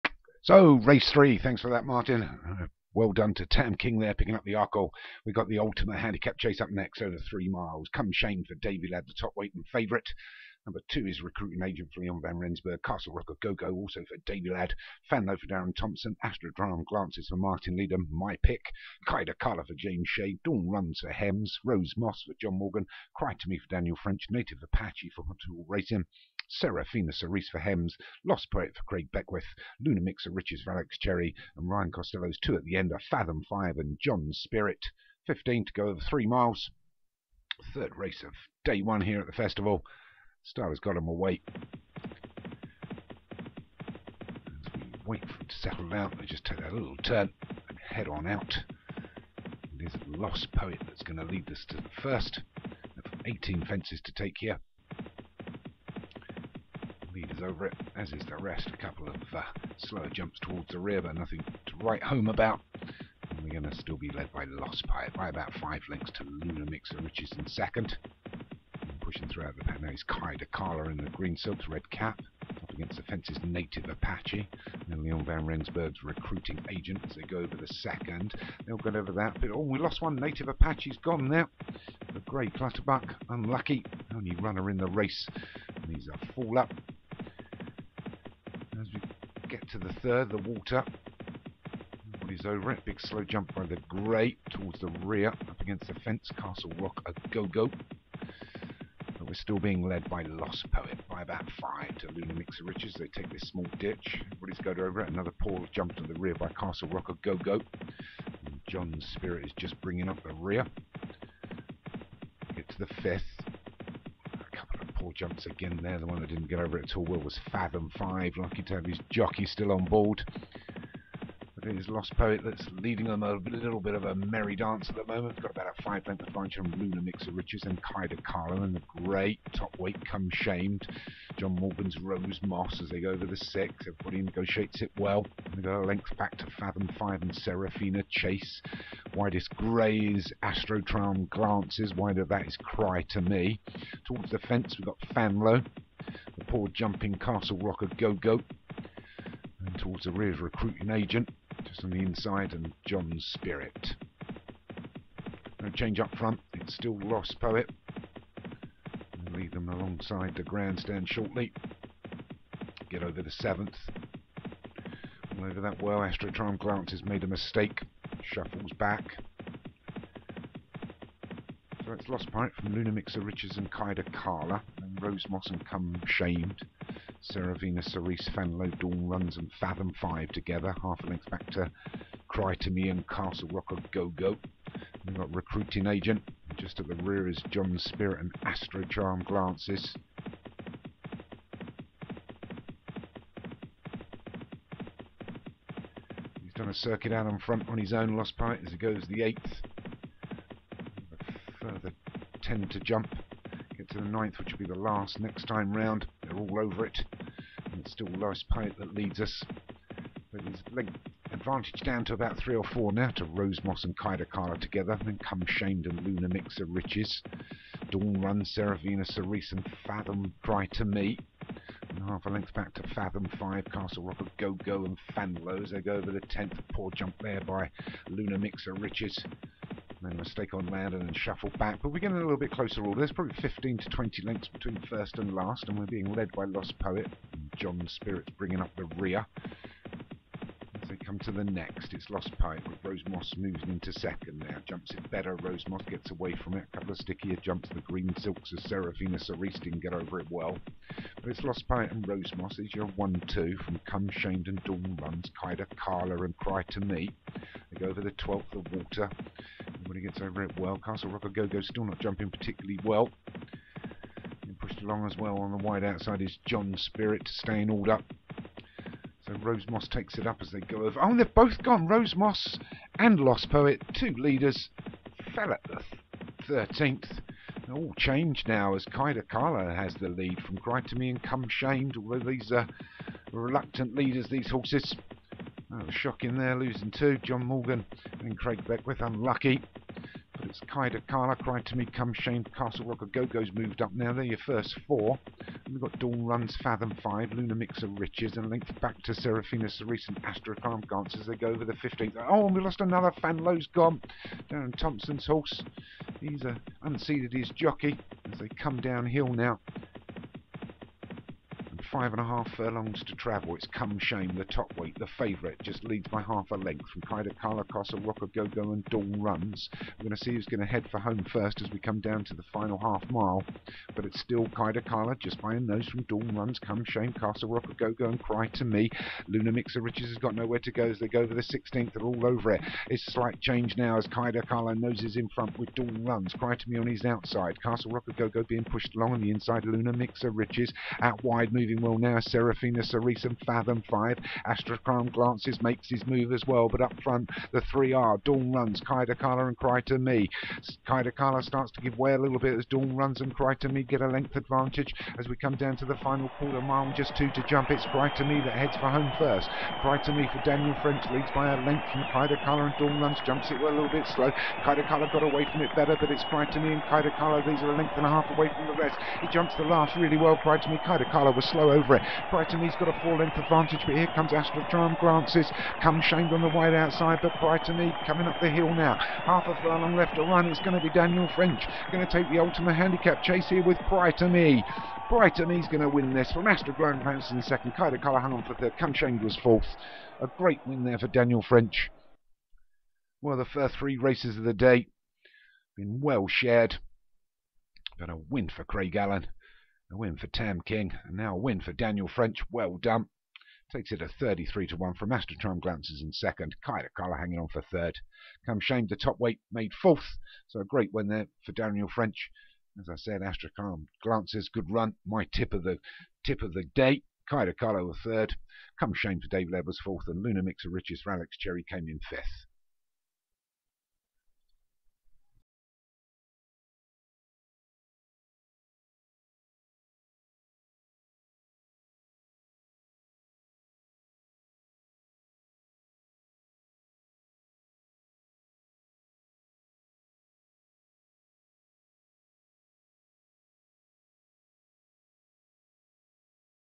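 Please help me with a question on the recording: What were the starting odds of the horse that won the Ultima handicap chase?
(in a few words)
33 to 1.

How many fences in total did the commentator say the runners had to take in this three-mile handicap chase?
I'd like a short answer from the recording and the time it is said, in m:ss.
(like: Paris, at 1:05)
18, at 0:53.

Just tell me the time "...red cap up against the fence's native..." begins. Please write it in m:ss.
1:11.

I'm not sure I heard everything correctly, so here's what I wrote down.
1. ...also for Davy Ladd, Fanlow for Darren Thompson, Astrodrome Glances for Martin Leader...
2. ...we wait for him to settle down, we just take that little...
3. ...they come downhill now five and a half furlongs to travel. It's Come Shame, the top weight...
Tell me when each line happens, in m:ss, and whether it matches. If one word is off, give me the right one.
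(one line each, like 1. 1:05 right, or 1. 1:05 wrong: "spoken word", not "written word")
1. 0:13 right
2. 0:44 right
3. 5:08 right.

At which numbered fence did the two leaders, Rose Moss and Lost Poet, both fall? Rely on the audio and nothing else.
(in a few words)
13th.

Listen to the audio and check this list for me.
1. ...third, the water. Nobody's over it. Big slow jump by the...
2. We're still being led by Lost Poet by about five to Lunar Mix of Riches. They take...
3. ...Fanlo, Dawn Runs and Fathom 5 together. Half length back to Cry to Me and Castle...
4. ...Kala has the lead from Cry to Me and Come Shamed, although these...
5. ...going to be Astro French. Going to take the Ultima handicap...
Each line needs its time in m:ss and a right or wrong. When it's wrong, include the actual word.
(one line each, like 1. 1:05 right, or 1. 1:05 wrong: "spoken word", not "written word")
1. 1:30 right
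2. 1:39 right
3. 2:58 right
4. 4:39 right
5. 6:20 wrong: "Daniel", not "Astro".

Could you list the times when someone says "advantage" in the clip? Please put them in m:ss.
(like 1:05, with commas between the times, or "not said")
2:06, 3:31, 5:54, 6:13.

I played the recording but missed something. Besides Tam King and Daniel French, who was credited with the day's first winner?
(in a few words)
Craig Allen.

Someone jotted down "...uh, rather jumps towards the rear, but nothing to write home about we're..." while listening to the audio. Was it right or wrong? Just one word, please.
wrong.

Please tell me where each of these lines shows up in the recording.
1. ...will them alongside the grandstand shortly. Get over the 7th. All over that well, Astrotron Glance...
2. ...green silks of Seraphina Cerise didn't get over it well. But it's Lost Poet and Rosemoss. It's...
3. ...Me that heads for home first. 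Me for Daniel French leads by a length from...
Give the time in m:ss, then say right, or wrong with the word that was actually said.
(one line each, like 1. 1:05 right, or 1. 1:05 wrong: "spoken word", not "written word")
1. 2:39 right
2. 4:07 right
3. 5:57 right.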